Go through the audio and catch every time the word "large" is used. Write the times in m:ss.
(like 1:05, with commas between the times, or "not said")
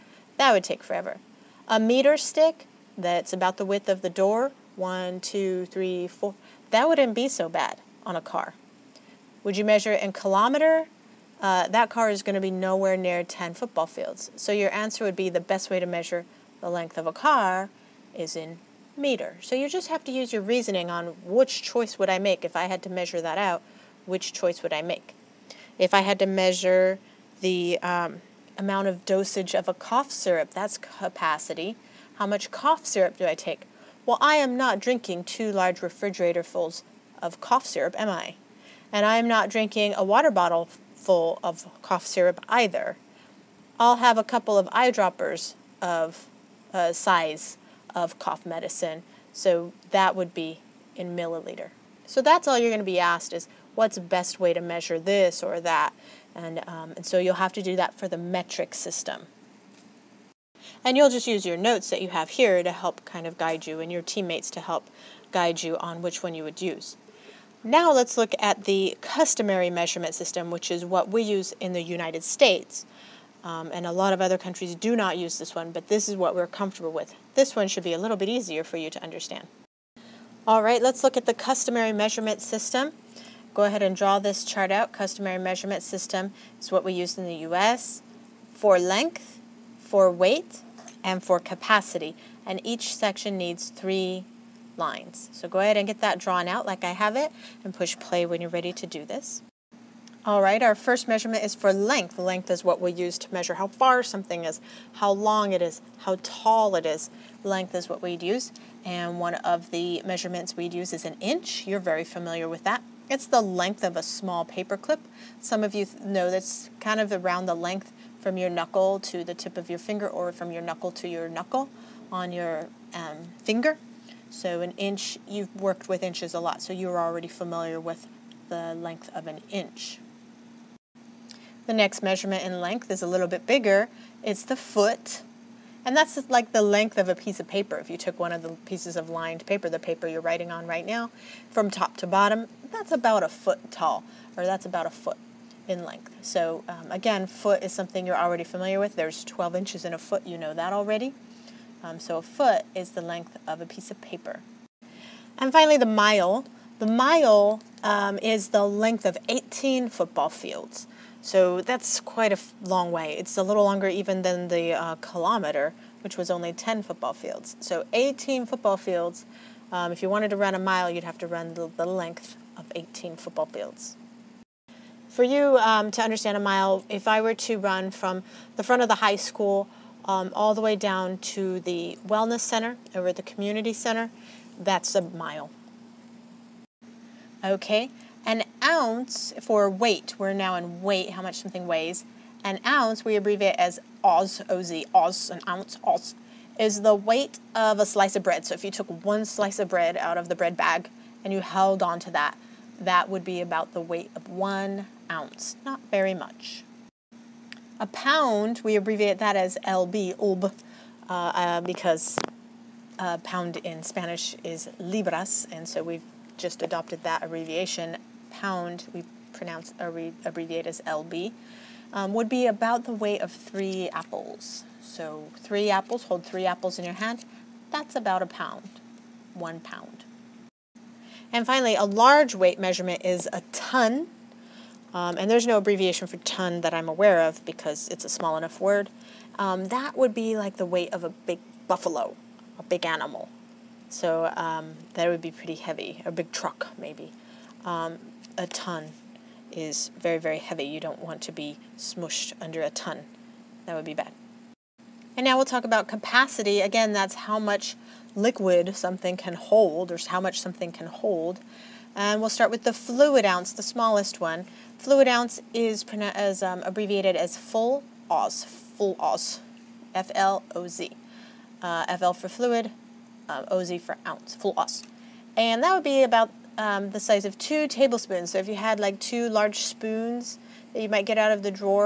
0:35, 3:51, 4:39.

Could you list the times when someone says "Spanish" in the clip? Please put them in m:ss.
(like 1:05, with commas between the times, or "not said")
3:33.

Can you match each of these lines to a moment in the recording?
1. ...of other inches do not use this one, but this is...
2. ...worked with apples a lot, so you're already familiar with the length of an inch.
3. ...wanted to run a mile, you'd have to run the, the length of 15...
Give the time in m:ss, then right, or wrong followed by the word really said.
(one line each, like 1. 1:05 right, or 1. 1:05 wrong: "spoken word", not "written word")
1. 1:14 wrong: "countries", not "inches"
2. 2:05 wrong: "inches", not "apples"
3. 2:50 wrong: "18", not "15".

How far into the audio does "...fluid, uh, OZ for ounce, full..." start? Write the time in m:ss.
4:32.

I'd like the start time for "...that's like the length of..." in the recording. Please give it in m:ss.
2:15.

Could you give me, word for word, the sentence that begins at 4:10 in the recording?
You don't want to be smushed under a ton.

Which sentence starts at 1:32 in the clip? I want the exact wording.
And each section needs three lines.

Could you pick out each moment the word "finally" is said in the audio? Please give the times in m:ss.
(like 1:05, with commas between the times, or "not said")
2:35, 3:51.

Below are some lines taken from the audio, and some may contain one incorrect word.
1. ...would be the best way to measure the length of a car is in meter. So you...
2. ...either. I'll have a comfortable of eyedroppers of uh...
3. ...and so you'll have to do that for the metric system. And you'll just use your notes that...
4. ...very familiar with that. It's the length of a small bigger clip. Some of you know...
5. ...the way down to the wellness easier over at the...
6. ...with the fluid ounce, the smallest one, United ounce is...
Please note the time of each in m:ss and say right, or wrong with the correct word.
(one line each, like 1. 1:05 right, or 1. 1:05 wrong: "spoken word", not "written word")
1. 0:15 right
2. 0:42 wrong: "couple", not "comfortable"
3. 0:56 right
4. 1:51 wrong: "paper", not "bigger"
5. 3:00 wrong: "center", not "easier"
6. 4:22 wrong: "Fluid", not "United".